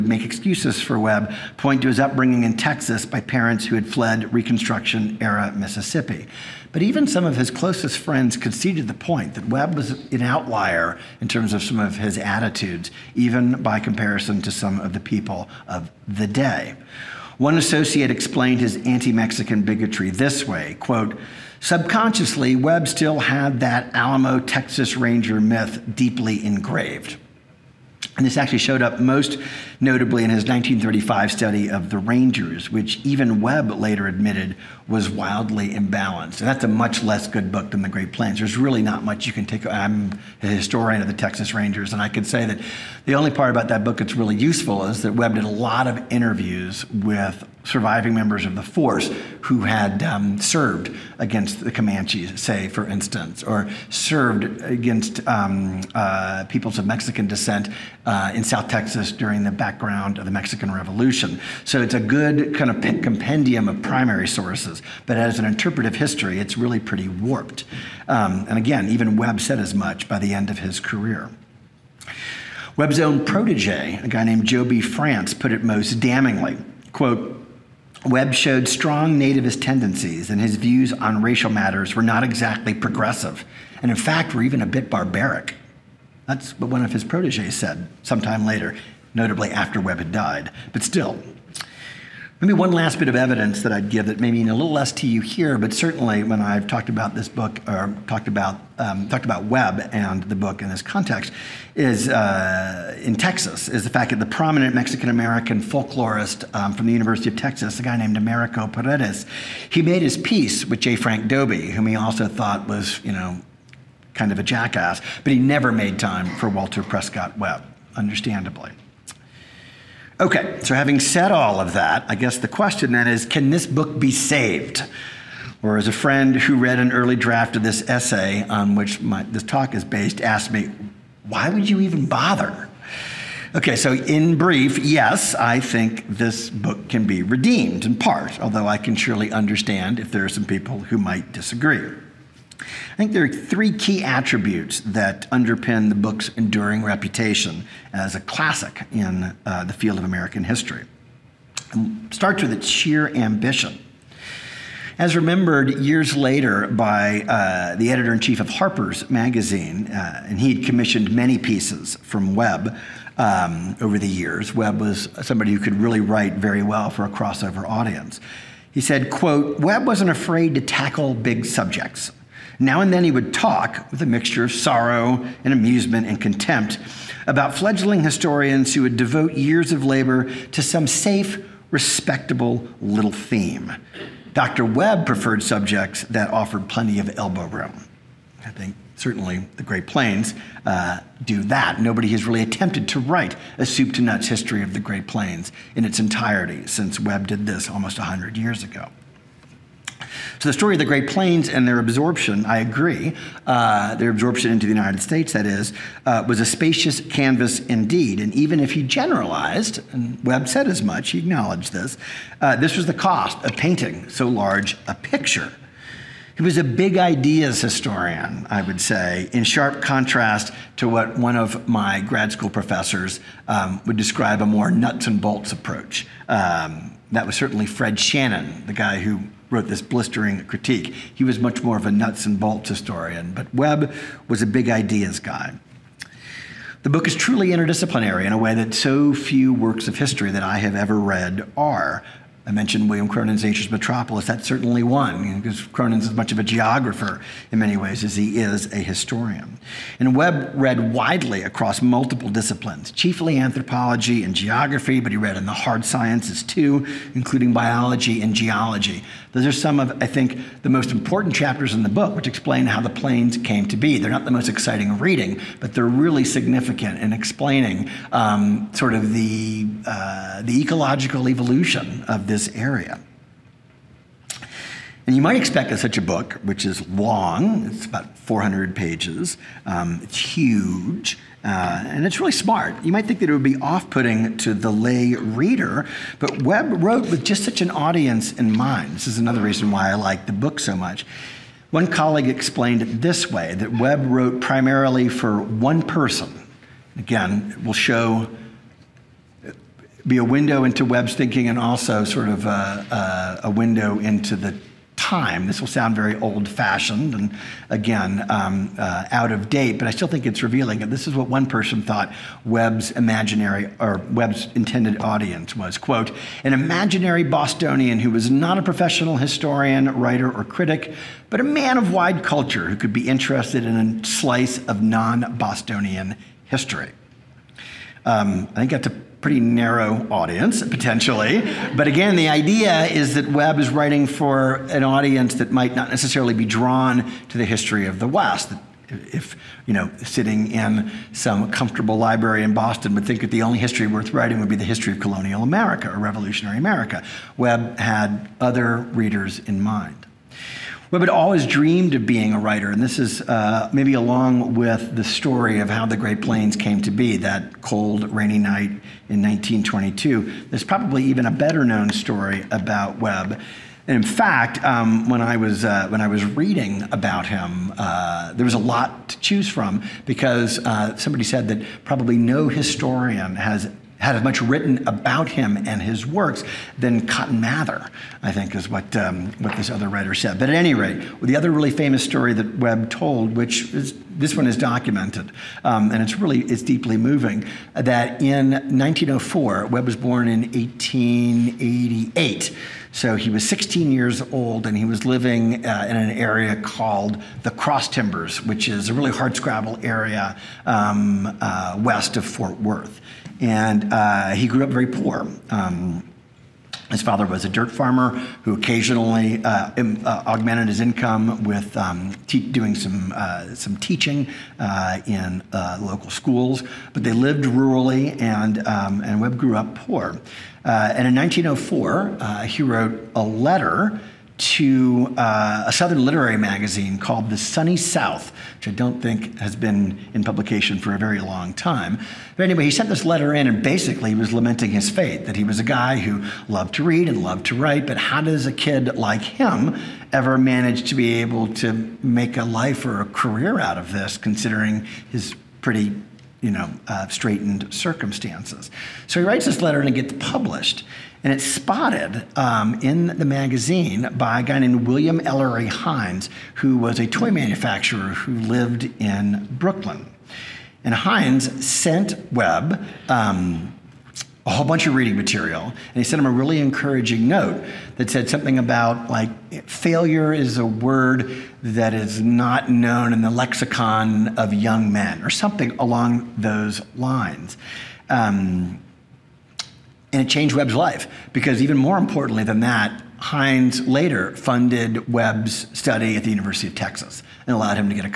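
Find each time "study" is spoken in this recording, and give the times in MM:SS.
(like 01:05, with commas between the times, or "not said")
00:31, 08:05.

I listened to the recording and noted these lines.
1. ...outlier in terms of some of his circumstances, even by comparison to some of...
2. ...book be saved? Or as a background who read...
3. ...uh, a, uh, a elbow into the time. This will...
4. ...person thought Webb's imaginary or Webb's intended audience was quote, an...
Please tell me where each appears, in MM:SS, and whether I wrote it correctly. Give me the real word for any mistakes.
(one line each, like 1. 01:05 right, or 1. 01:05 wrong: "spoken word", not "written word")
1. 00:10 wrong: "attitudes", not "circumstances"
2. 02:03 wrong: "friend", not "background"
3. 05:02 wrong: "window", not "elbow"
4. 05:11 right.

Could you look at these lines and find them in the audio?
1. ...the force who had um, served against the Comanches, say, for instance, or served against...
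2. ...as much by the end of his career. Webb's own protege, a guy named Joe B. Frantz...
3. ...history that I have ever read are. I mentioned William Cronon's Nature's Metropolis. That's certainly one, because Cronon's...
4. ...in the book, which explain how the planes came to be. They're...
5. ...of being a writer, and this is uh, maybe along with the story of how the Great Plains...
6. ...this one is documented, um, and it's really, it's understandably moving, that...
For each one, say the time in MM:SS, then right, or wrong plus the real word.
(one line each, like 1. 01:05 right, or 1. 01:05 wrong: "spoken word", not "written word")
1. 00:48 right
2. 01:09 right
3. 03:59 right
4. 04:21 right
5. 05:51 right
6. 06:24 wrong: "deeply", not "understandably".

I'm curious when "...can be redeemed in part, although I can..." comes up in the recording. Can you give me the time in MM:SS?
02:16.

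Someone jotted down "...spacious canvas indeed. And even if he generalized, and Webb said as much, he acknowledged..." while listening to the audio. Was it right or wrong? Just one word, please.
right.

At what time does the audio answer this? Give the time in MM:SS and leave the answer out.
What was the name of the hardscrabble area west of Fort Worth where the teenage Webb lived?
06:37.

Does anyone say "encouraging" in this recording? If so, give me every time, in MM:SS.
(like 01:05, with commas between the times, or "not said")
07:46.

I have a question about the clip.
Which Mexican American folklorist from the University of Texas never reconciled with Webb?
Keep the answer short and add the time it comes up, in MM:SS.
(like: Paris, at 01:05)
Americo Paredes, at 01:48.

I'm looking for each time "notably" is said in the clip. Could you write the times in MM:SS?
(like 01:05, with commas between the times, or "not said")
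00:29, 01:29.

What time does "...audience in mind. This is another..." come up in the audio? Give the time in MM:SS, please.
04:47.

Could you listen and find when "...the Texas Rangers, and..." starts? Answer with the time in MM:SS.
00:41.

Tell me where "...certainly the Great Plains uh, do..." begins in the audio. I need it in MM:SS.
03:08.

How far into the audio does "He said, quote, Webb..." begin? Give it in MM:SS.
02:48.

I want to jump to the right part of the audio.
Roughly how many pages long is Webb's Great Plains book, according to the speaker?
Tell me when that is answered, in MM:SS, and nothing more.
04:38.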